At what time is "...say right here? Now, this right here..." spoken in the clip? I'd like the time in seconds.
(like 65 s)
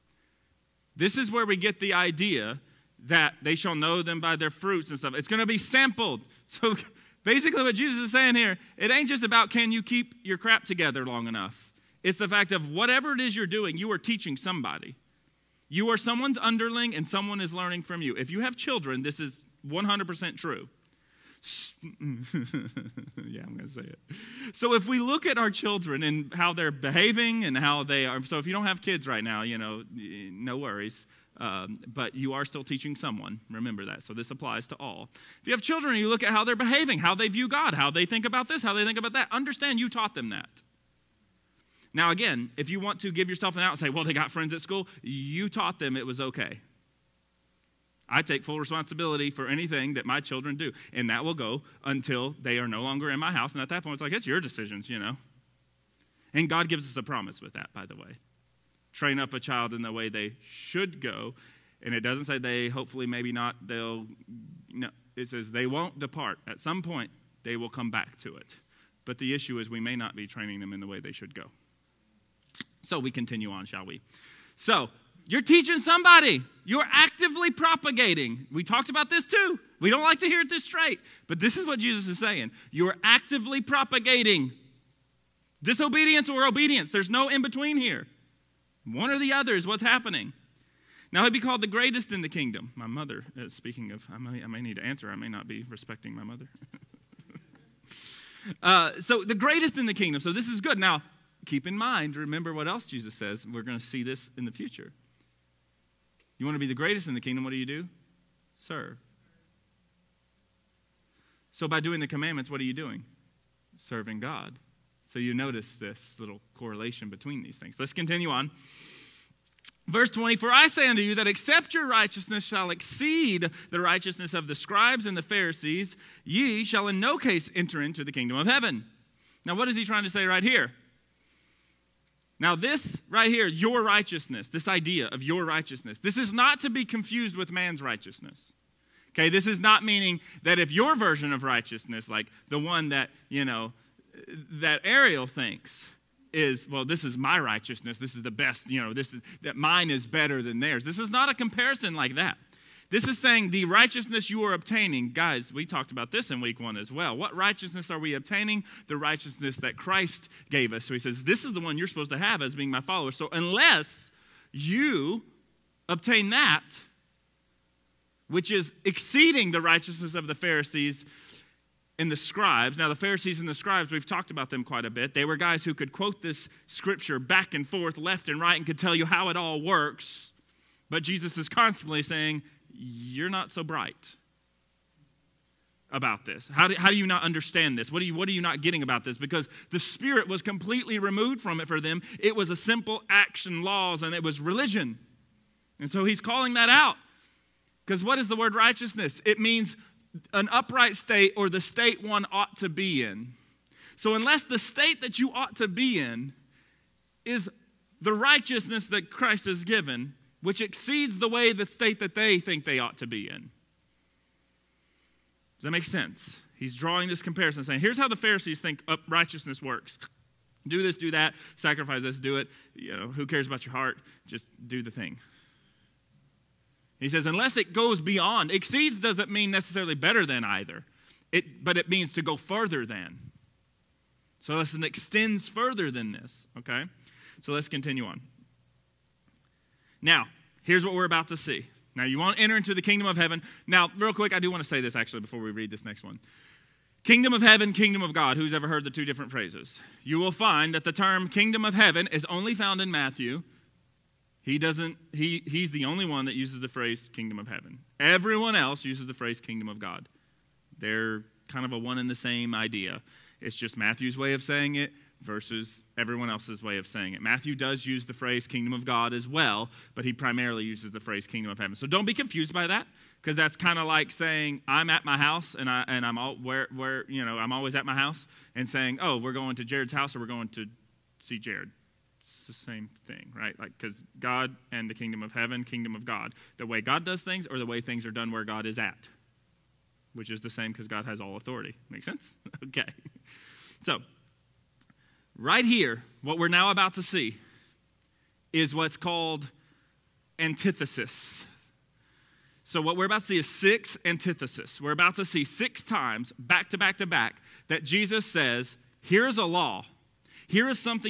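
130 s.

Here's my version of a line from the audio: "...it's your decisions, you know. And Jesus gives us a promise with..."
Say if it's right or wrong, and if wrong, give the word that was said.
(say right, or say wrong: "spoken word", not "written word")
wrong: "God", not "Jesus".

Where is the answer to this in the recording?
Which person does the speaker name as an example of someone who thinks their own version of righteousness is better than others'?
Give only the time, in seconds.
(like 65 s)
144 s.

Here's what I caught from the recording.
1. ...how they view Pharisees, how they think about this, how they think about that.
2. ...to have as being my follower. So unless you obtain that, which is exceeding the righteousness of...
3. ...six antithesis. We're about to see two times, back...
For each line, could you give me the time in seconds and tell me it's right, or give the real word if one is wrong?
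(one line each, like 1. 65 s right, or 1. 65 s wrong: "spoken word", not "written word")
1. 36 s wrong: "God", not "Pharisees"
2. 162 s right
3. 303 s wrong: "six", not "two".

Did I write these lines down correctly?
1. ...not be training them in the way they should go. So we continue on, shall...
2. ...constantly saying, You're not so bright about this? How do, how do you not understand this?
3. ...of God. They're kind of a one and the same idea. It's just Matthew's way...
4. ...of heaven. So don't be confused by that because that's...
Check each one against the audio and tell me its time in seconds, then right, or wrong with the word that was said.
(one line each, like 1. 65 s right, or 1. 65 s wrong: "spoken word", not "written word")
1. 69 s right
2. 181 s right
3. 259 s right
4. 271 s right.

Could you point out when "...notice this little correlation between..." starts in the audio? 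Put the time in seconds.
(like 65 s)
115 s.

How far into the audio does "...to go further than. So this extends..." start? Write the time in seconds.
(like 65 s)
232 s.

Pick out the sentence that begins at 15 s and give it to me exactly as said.
You are someone's underling and someone is learning from you.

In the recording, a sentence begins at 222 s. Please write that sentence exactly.
You know, who cares about your heart?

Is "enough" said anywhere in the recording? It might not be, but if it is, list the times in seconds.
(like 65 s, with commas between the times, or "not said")
11 s.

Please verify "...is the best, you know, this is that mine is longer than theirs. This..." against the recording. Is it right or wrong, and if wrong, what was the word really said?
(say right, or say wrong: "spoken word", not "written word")
wrong: "better", not "longer".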